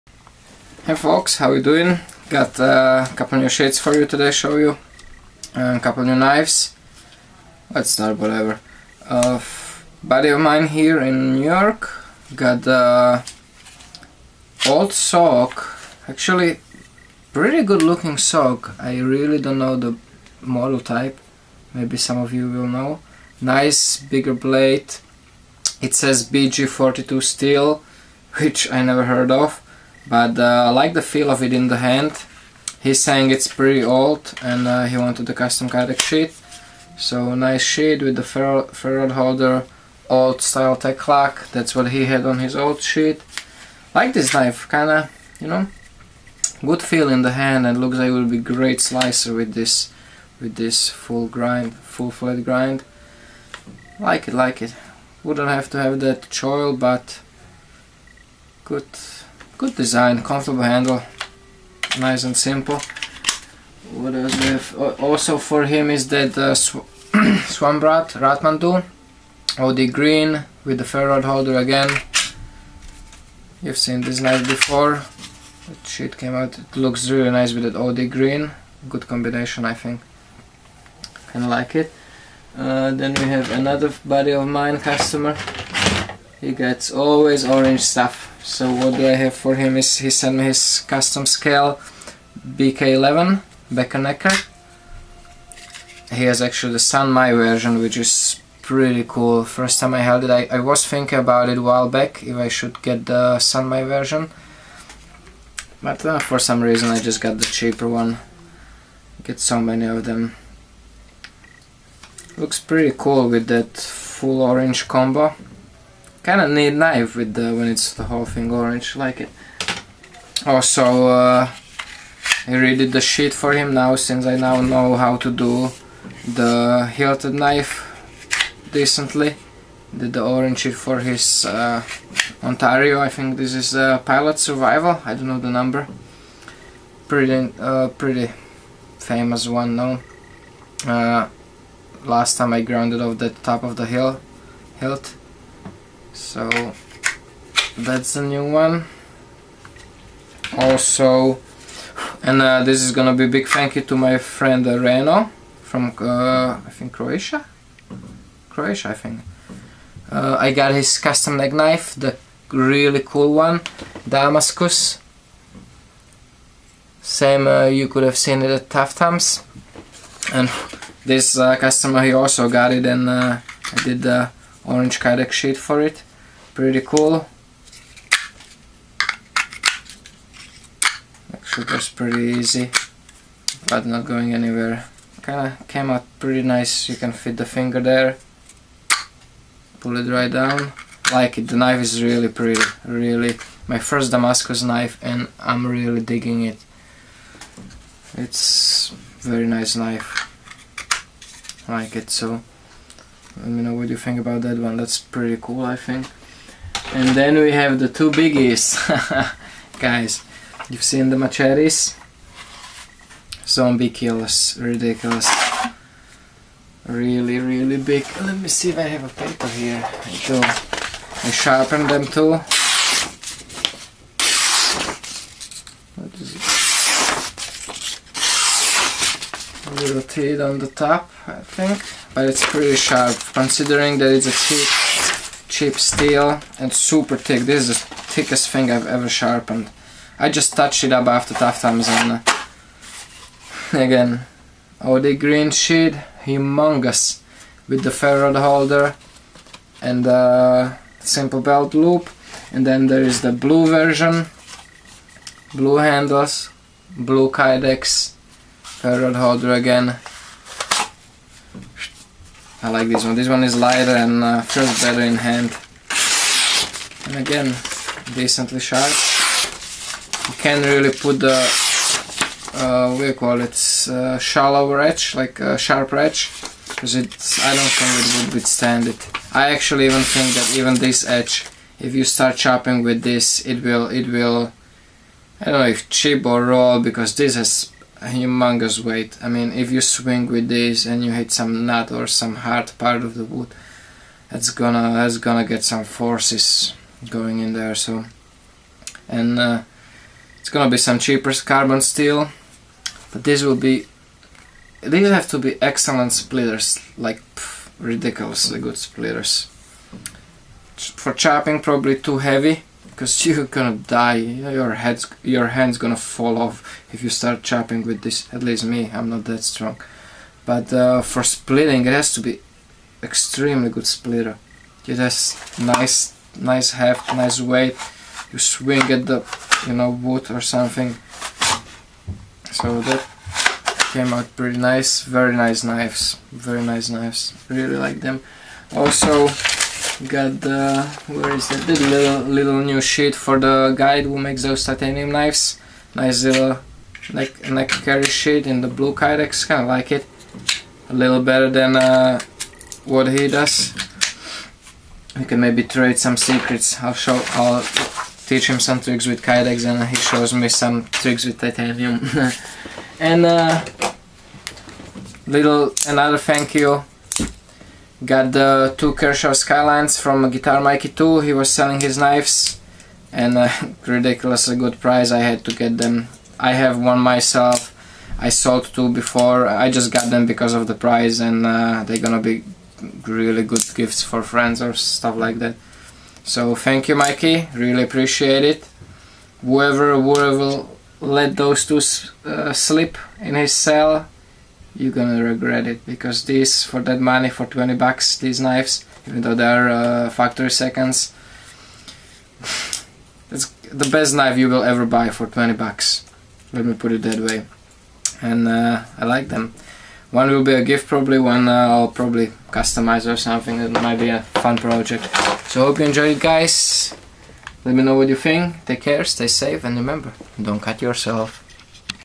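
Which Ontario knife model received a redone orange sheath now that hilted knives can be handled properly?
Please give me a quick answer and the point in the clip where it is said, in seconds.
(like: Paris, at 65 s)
Pilot Survival, at 133 s.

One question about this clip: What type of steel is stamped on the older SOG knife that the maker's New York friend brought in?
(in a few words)
BG42.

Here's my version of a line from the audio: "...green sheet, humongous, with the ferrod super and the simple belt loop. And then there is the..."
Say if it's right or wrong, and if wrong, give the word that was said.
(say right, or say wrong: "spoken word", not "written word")
wrong: "holder", not "super".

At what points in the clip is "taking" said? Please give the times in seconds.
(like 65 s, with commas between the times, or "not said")
not said.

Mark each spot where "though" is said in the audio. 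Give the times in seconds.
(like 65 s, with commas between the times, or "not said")
399 s.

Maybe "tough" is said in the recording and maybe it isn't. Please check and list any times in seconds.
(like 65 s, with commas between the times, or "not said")
168 s, 241 s.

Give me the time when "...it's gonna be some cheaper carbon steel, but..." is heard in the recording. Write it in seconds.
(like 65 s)
300 s.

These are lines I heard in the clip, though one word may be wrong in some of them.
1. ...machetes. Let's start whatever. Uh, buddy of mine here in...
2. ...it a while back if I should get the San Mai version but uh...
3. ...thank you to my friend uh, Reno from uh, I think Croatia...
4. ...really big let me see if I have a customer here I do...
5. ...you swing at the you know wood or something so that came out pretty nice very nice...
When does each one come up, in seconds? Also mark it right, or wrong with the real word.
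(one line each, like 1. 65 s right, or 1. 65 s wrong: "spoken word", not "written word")
1. 6 s wrong: "knives", not "machetes"
2. 101 s right
3. 153 s right
4. 217 s wrong: "paper", not "customer"
5. 328 s right.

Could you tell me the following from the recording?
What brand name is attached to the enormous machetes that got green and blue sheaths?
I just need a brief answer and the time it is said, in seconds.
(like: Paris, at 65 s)
Zombie Kills, at 213 s.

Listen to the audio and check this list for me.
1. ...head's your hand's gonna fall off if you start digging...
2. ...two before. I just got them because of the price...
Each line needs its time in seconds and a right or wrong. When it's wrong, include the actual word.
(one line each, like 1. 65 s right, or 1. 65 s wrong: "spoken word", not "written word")
1. 314 s wrong: "chopping", not "digging"
2. 378 s right.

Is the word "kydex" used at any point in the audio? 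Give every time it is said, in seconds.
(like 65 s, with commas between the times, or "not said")
35 s, 175 s, 257 s, 348 s, 359 s.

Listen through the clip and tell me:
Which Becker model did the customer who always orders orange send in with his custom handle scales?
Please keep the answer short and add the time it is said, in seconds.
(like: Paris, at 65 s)
BK11, at 92 s.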